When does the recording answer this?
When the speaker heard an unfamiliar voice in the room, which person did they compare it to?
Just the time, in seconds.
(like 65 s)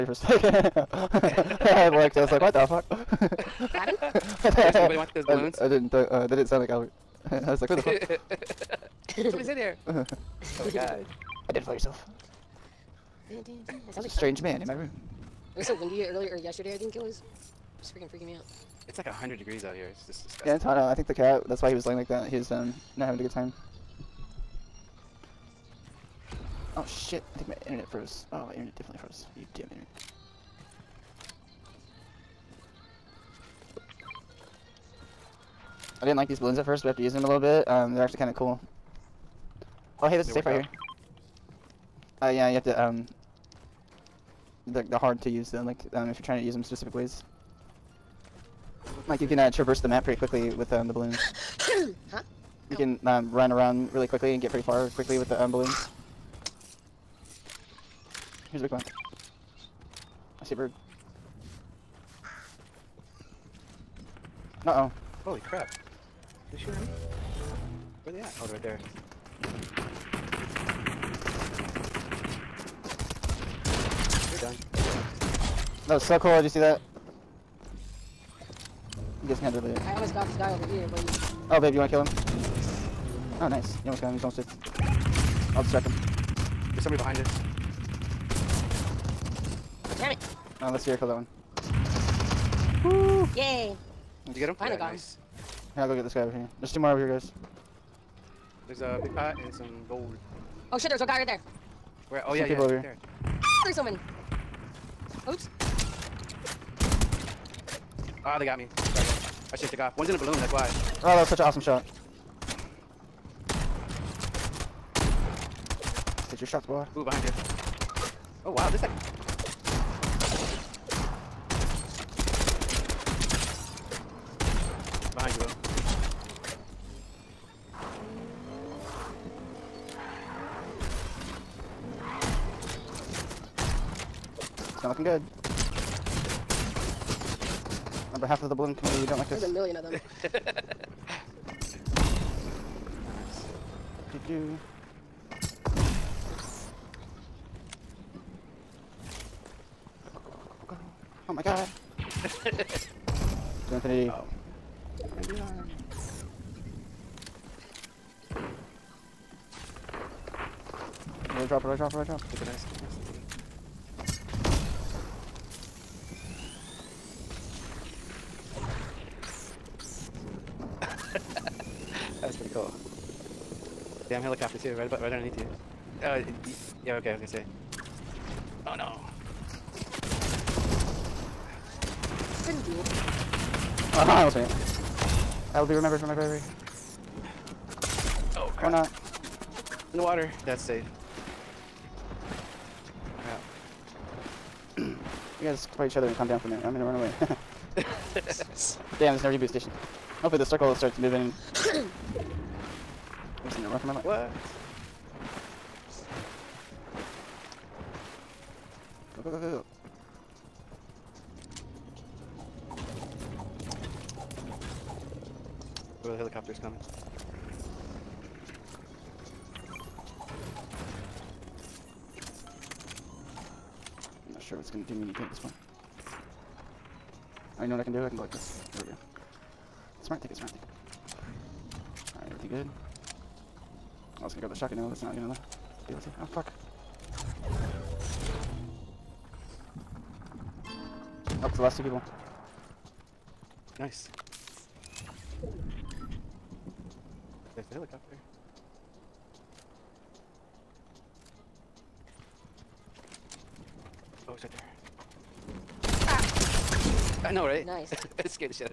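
6 s.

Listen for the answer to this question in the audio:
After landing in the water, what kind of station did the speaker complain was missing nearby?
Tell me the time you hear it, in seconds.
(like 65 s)
199 s.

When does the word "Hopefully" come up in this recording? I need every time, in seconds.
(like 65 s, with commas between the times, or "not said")
200 s.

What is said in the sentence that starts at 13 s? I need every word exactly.
Like strange man in my room.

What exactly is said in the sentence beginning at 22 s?
He was um not having a good time.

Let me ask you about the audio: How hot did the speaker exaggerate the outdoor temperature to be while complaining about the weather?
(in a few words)
100 degrees.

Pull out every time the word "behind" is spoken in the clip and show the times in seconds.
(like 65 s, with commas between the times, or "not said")
86 s, 117 s.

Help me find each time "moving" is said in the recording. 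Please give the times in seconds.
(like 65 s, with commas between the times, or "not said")
200 s.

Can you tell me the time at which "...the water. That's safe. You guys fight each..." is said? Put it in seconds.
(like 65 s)
189 s.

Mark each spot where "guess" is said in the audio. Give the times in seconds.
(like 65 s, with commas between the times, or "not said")
79 s.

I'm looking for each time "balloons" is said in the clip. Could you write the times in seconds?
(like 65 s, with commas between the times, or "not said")
5 s, 36 s, 50 s, 55 s, 110 s, 138 s.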